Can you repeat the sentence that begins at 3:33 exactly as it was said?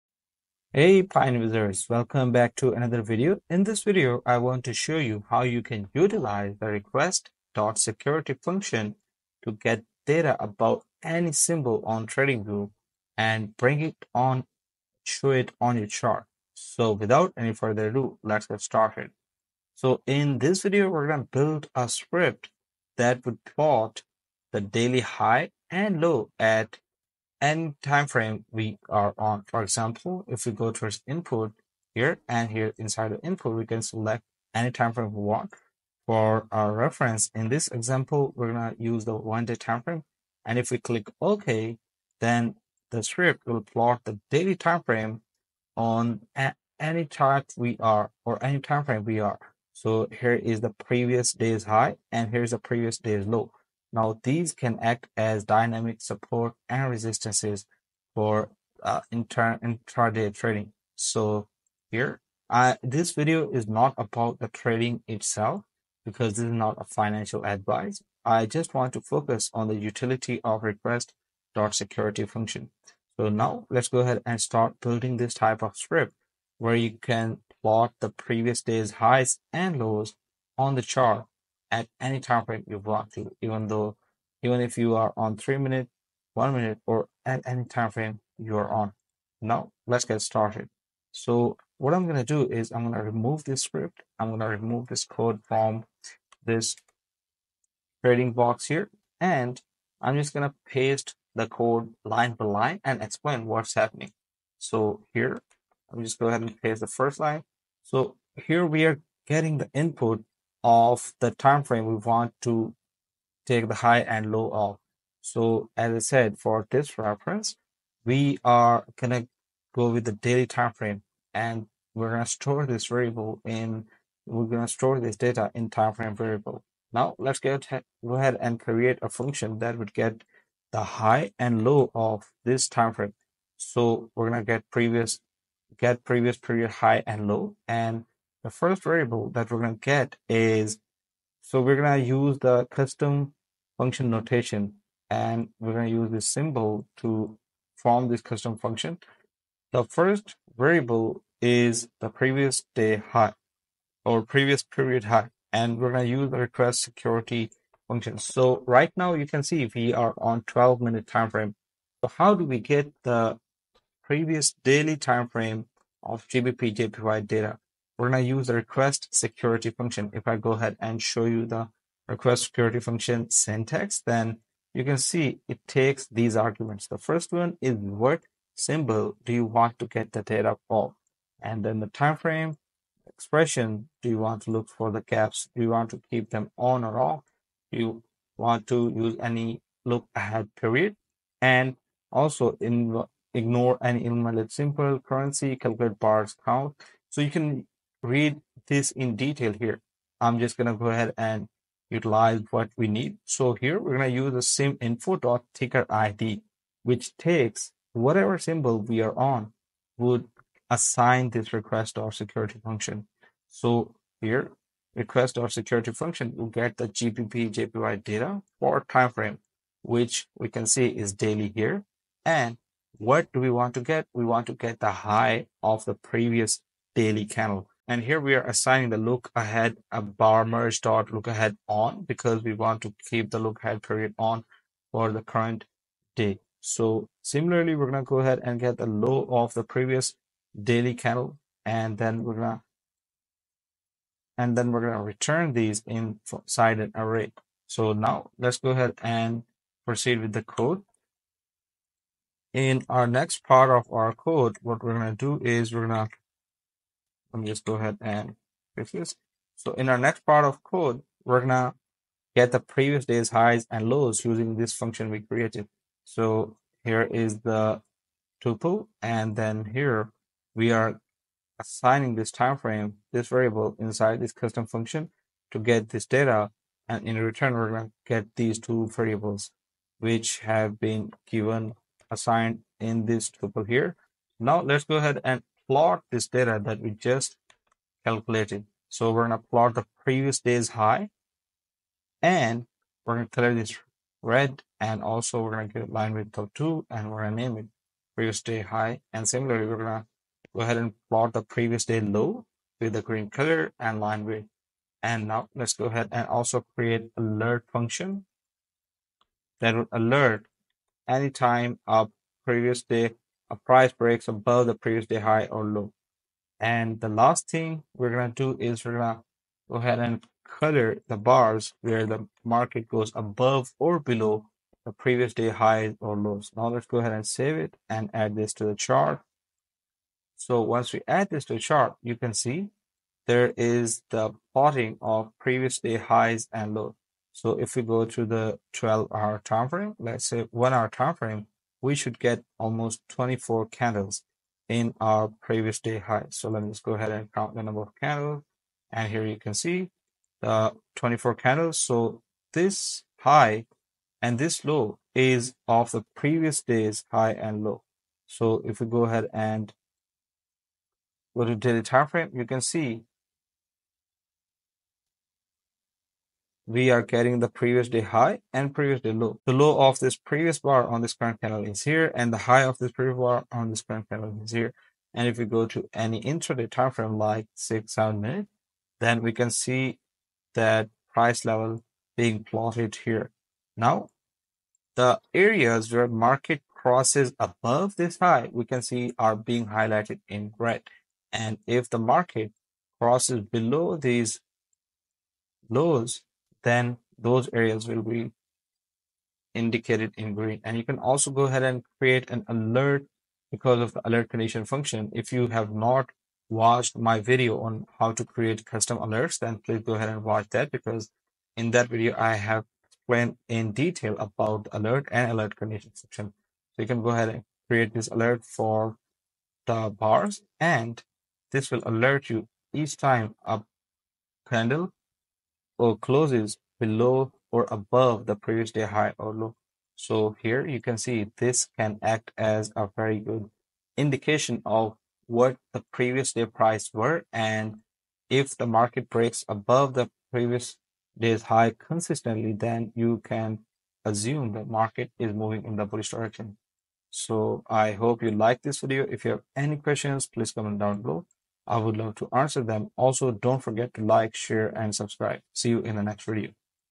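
So here request or security function will get the GBP JPY data for time frame, which we can see is daily here.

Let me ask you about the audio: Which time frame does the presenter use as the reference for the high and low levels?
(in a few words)
one day.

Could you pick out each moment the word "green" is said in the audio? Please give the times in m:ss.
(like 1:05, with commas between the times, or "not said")
5:03, 6:40.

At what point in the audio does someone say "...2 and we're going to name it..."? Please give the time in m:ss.
4:56.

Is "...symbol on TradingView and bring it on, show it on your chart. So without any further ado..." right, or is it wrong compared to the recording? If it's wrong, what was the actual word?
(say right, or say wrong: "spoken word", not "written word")
right.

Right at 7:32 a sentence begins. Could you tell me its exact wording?
Also, don't forget to like, share, and subscribe.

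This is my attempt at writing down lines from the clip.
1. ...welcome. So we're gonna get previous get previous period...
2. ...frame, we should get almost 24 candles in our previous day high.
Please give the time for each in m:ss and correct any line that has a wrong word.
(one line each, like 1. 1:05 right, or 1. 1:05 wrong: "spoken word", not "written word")
1. 2:12 wrong: "frame", not "welcome"
2. 5:41 right.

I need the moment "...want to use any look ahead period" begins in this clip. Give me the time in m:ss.
3:08.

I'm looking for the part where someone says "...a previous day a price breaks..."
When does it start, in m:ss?
5:11.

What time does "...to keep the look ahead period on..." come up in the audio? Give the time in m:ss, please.
3:52.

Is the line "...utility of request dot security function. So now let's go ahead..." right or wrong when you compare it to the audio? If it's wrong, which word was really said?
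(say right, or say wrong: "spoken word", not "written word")
right.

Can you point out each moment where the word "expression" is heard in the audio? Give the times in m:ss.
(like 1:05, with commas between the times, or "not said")
3:03.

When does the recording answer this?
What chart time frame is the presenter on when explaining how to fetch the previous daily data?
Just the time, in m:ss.
2:40.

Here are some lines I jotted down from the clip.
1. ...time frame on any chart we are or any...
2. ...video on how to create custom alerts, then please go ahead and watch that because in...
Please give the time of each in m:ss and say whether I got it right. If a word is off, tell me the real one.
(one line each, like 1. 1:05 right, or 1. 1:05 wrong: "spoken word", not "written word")
1. 0:44 right
2. 6:47 right.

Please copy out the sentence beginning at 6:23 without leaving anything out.
Now, the areas where market crosses above this high, we can see are being highlighted in red.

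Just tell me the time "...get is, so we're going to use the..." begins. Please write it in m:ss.
2:19.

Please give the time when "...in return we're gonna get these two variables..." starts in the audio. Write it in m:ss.
4:37.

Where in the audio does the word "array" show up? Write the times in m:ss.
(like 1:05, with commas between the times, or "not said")
4:06.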